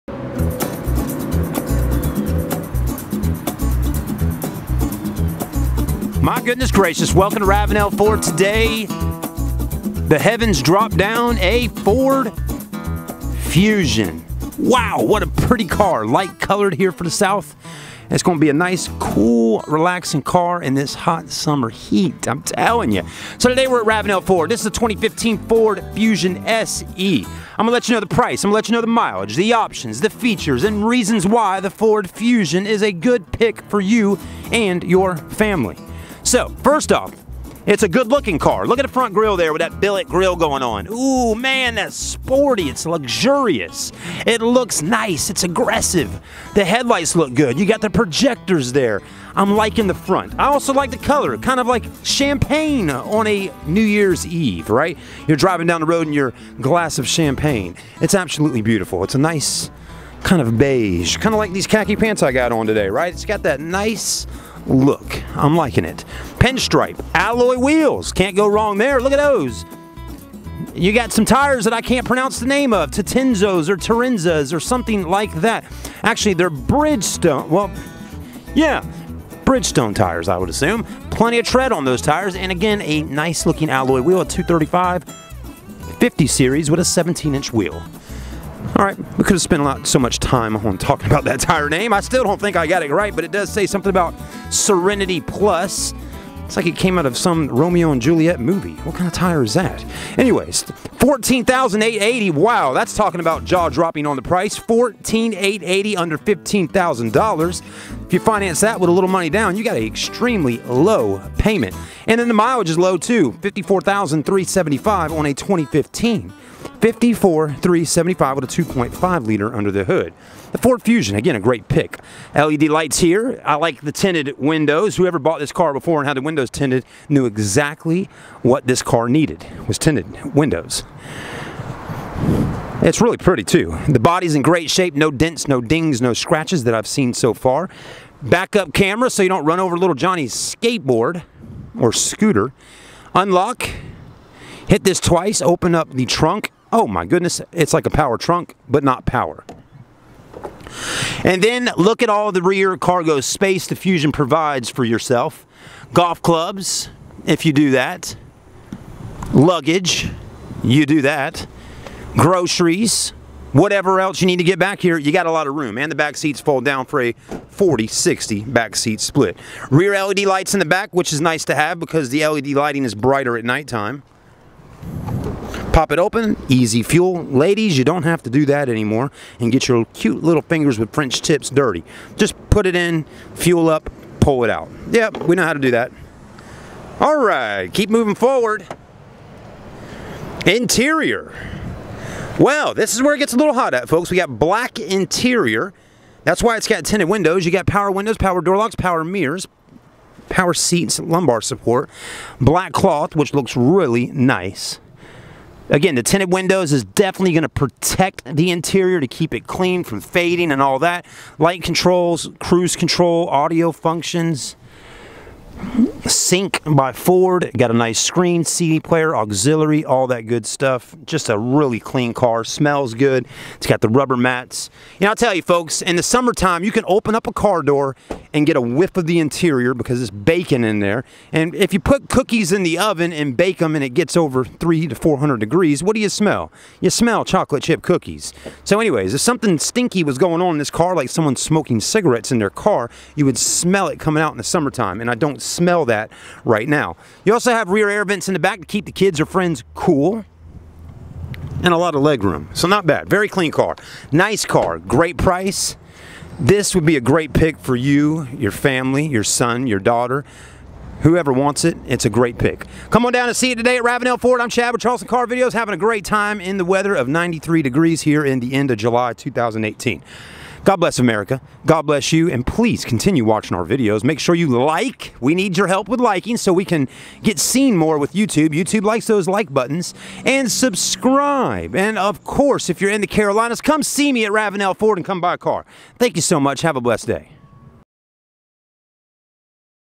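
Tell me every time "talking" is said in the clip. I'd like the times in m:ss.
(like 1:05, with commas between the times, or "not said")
1:30, 1:42.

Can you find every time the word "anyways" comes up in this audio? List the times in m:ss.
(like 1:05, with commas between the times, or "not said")
1:40, 3:58.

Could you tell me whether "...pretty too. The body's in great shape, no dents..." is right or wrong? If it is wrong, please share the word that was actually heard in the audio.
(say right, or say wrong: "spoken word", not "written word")
right.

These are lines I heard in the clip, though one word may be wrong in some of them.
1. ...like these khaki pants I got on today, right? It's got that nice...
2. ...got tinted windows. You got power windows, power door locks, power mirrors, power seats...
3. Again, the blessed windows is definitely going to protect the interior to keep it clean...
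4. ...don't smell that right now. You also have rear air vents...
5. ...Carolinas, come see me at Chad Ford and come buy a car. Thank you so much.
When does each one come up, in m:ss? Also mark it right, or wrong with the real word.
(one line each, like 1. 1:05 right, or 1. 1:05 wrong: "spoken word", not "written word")
1. 1:01 right
2. 3:16 right
3. 3:25 wrong: "tinted", not "blessed"
4. 4:05 right
5. 4:43 wrong: "Ravenel", not "Chad".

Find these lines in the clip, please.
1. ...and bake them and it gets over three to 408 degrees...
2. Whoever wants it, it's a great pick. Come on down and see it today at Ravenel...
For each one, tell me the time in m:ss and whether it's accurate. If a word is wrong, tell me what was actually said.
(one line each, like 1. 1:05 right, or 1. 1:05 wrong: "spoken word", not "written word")
1. 3:53 wrong: "400", not "408"
2. 4:21 right.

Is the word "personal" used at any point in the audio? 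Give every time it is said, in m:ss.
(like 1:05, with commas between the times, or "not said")
not said.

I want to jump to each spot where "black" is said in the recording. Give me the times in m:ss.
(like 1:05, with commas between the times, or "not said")
3:14, 3:22.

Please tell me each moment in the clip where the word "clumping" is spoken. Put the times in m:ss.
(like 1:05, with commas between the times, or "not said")
not said.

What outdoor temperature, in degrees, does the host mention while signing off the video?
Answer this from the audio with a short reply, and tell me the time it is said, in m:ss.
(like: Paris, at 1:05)
93, at 4:27.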